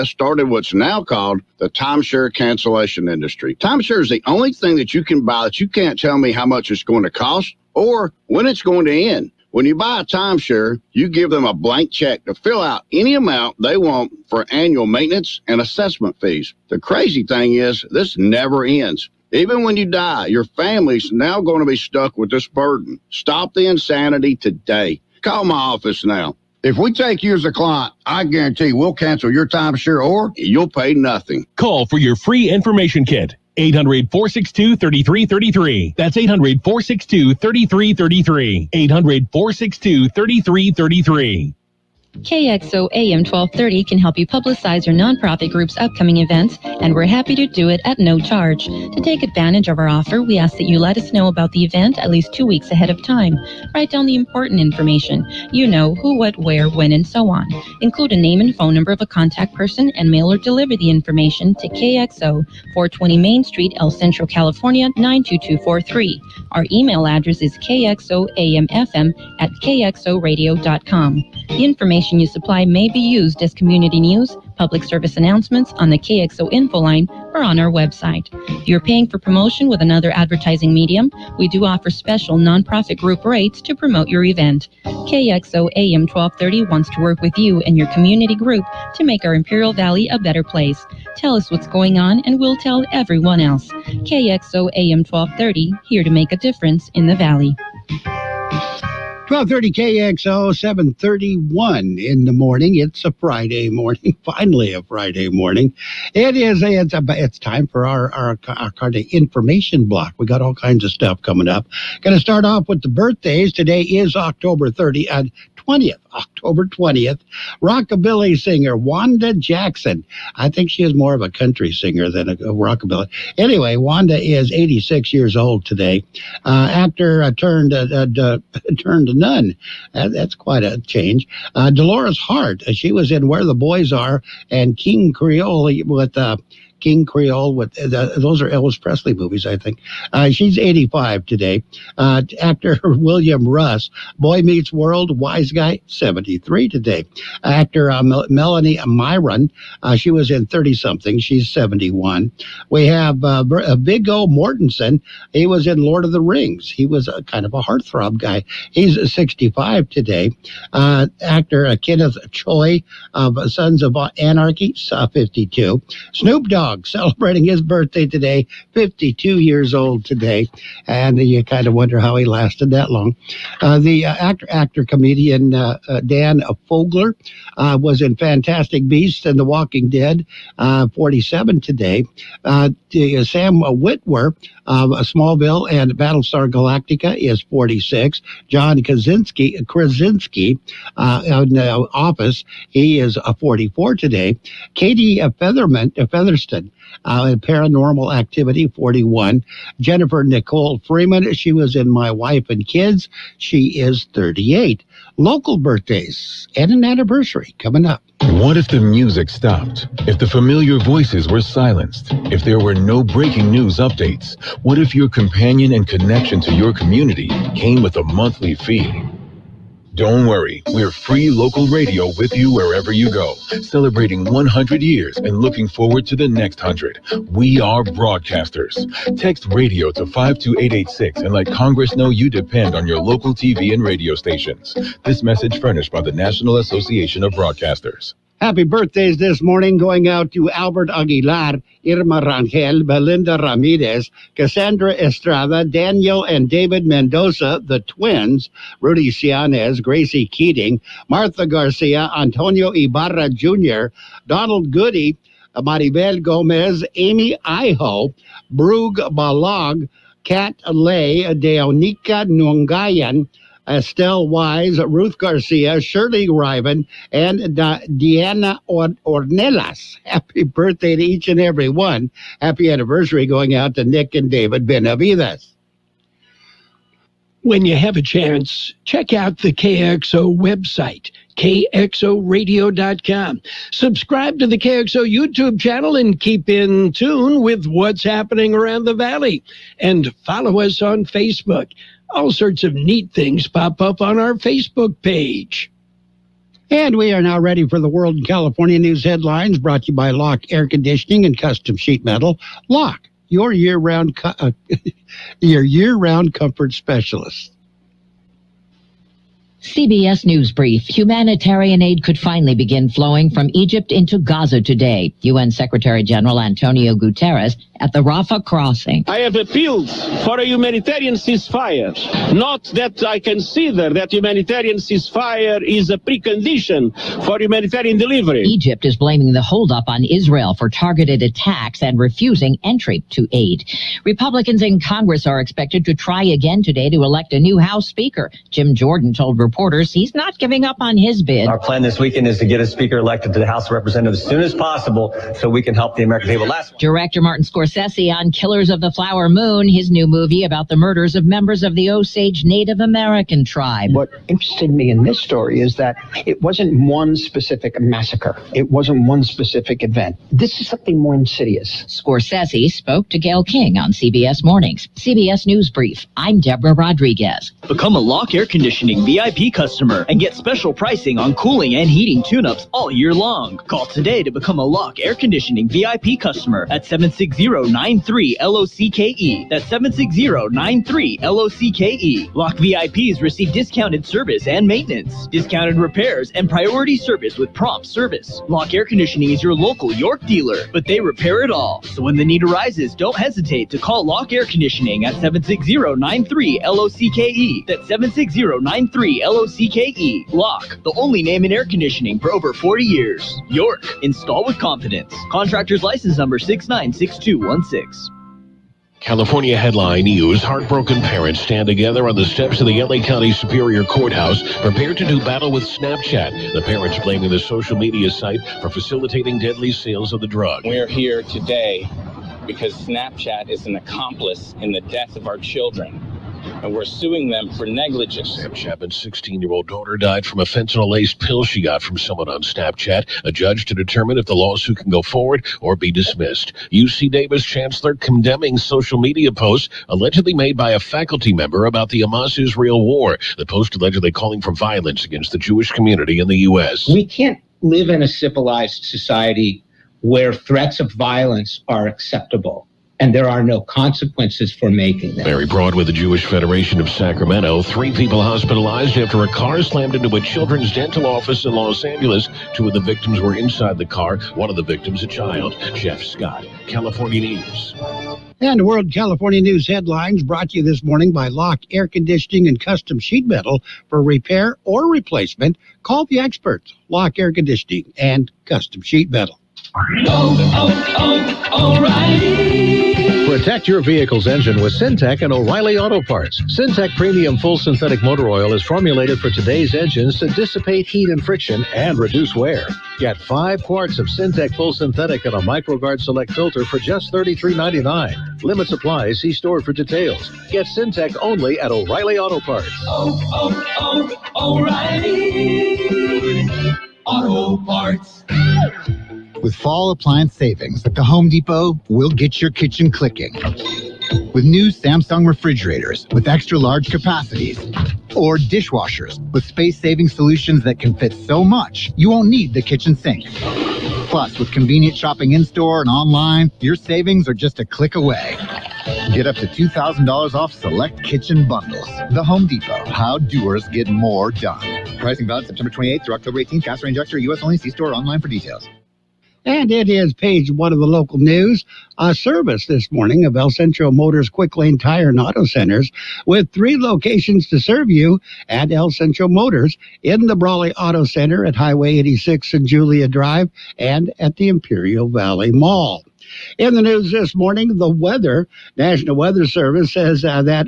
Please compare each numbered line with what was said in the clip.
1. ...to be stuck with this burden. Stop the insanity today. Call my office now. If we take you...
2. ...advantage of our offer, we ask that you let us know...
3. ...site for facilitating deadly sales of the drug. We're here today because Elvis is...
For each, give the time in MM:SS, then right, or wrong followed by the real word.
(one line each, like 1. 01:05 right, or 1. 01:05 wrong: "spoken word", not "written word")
1. 00:21 right
2. 00:49 right
3. 06:58 wrong: "Snapchat", not "Elvis".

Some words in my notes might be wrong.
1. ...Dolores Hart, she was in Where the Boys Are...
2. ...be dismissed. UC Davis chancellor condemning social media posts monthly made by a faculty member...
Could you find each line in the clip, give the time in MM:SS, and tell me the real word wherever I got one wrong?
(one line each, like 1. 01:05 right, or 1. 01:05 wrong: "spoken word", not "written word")
1. 02:11 right
2. 07:15 wrong: "allegedly", not "monthly".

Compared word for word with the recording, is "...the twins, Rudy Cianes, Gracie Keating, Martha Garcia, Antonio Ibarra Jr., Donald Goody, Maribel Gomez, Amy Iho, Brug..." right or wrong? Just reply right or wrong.
right.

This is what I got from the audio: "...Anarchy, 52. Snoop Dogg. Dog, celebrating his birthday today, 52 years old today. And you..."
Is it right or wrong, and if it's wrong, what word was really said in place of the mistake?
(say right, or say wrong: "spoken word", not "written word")
right.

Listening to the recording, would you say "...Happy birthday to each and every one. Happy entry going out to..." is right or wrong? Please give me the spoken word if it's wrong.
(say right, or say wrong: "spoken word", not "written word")
wrong: "anniversary", not "entry".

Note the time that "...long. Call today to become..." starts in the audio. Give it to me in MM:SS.
06:13.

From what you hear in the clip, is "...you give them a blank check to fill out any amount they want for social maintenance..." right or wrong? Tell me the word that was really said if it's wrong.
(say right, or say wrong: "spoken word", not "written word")
wrong: "annual", not "social".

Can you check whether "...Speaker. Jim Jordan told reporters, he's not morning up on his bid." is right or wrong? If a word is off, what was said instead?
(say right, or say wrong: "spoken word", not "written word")
wrong: "giving", not "morning".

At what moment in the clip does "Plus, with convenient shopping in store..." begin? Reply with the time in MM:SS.
08:44.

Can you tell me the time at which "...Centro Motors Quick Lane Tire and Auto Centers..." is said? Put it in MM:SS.
09:03.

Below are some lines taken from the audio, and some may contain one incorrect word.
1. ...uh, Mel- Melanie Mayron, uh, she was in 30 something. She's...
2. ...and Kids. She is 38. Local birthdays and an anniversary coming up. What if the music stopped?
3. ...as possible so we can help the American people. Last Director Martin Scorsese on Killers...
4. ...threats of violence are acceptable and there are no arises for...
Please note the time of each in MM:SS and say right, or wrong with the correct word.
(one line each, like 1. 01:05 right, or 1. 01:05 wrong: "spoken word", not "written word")
1. 02:27 right
2. 03:22 right
3. 05:44 right
4. 07:30 wrong: "consequences", not "arises".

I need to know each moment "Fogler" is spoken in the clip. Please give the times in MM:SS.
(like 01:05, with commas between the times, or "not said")
02:56.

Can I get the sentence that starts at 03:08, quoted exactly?
John Krasinski, Krasinski in the office, he is 44 today.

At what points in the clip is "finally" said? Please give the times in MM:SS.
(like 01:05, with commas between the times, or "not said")
01:44, 05:12.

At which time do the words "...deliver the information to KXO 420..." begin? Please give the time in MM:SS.
01:00.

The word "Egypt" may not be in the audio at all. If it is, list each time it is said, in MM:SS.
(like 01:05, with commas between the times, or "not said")
05:13, 05:28.